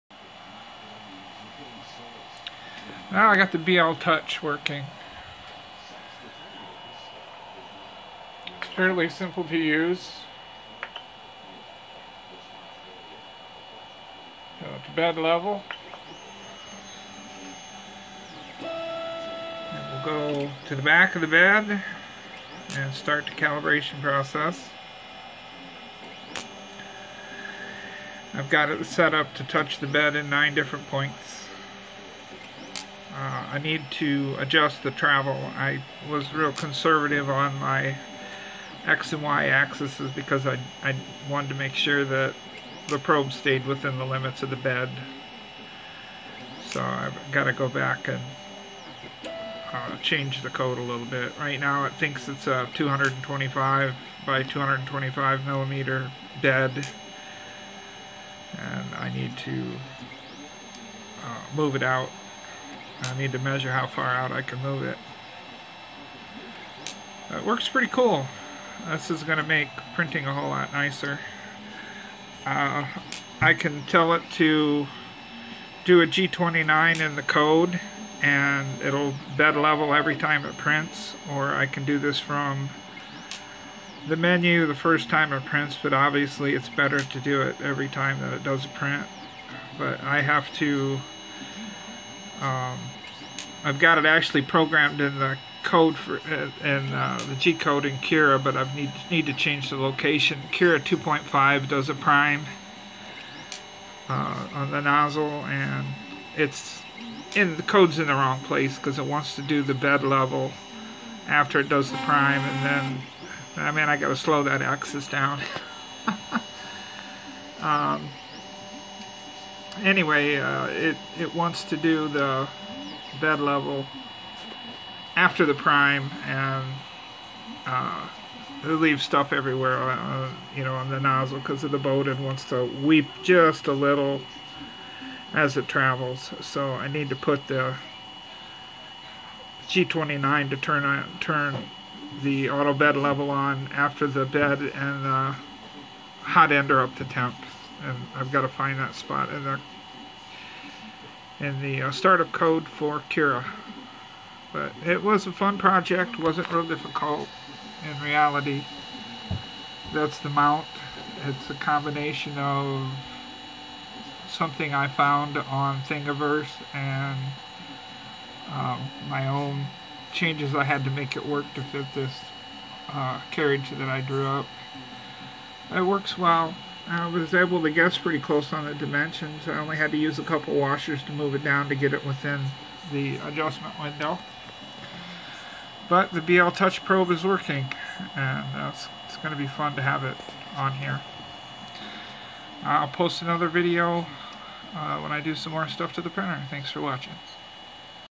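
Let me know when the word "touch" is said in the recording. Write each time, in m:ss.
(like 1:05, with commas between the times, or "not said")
0:03, 0:29, 3:06.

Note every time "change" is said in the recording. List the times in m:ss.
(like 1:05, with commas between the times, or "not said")
0:50, 1:39, 2:50.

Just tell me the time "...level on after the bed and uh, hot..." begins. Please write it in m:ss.
2:22.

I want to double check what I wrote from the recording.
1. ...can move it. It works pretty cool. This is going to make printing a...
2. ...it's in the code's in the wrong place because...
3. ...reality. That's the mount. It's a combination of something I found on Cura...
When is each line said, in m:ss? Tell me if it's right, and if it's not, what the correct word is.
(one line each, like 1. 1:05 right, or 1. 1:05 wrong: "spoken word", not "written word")
1. 1:04 right
2. 1:46 right
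3. 2:38 wrong: "Thingiverse", not "Cura".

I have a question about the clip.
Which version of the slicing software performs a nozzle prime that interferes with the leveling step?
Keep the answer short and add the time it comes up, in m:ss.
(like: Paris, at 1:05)
Cura 2.5, at 1:40.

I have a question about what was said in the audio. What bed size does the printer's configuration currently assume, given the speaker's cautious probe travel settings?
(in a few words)
225 by 225 millimeters.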